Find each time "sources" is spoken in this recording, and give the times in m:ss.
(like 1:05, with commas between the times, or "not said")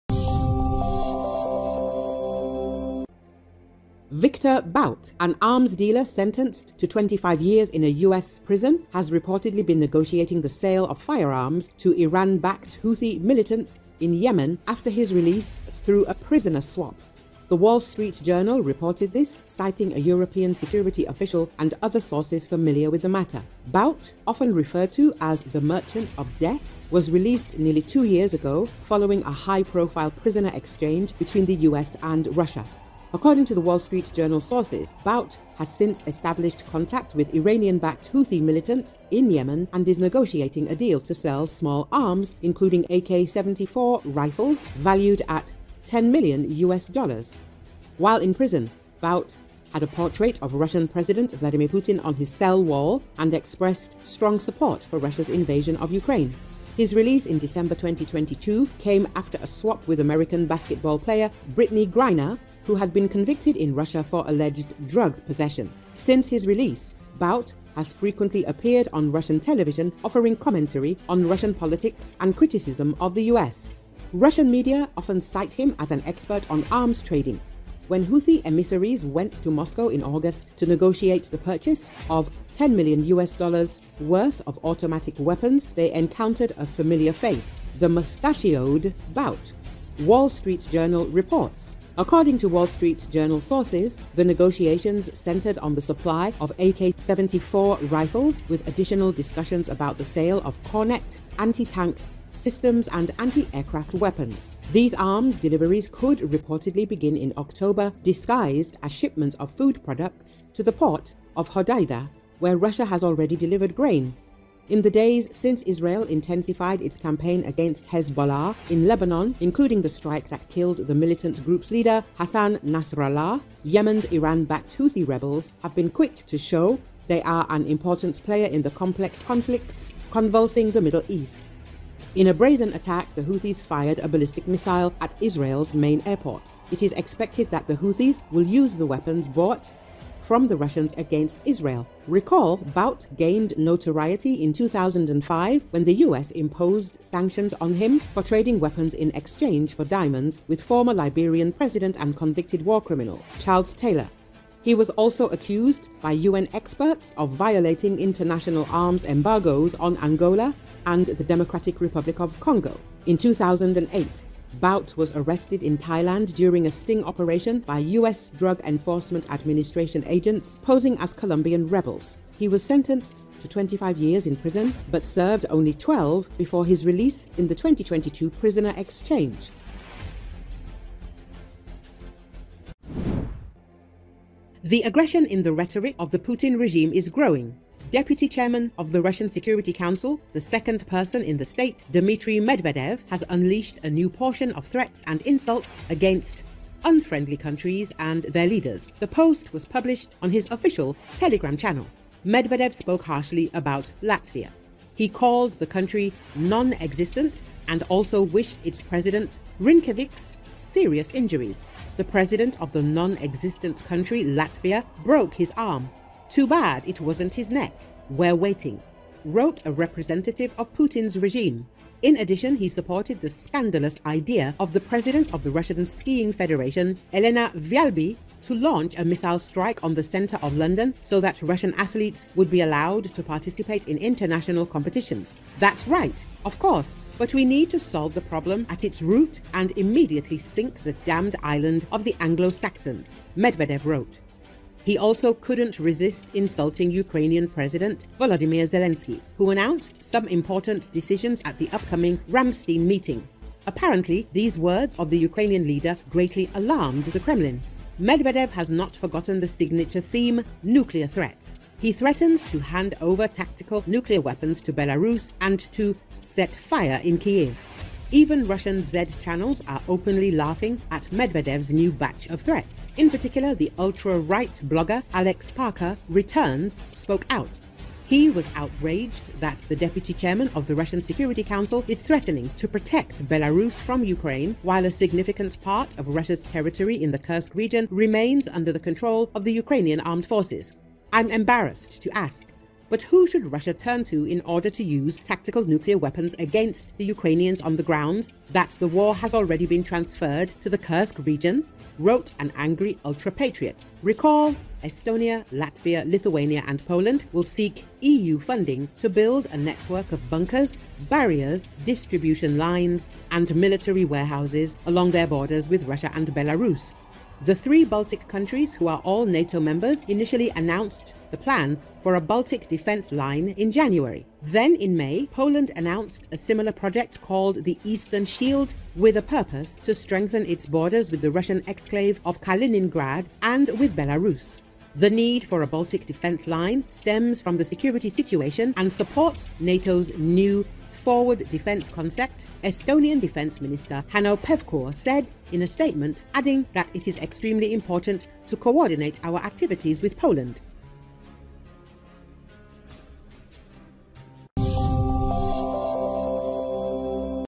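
0:22, 0:34, 1:33.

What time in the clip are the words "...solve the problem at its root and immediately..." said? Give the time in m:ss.
3:57.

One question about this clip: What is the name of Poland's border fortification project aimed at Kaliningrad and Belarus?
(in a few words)
Eastern Shield.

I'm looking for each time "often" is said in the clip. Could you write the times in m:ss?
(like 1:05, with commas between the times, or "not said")
0:24, 1:14.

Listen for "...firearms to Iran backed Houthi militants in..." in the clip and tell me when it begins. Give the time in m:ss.
0:11.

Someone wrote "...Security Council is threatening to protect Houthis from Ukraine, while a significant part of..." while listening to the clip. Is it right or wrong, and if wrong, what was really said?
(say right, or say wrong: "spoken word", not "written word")
wrong: "Belarus", not "Houthis".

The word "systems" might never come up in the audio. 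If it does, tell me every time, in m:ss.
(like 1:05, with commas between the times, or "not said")
1:42.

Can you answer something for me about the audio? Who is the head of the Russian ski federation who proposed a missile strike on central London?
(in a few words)
Elena Välbe.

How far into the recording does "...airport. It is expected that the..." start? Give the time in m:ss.
2:16.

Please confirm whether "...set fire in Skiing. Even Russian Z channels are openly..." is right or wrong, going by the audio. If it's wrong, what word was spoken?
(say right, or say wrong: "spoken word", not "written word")
wrong: "Kiev", not "Skiing".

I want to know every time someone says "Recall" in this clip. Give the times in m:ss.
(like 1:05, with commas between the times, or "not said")
2:22, 5:04.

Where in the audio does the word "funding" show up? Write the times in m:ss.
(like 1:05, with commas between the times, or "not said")
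5:08.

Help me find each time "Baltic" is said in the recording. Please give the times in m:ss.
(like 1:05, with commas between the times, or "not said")
5:17, 5:22, 5:35.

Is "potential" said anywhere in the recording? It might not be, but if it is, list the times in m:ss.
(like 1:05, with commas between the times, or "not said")
not said.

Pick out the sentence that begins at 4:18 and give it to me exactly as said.
Medvedev has not forgotten the signature theme, nuclear threats.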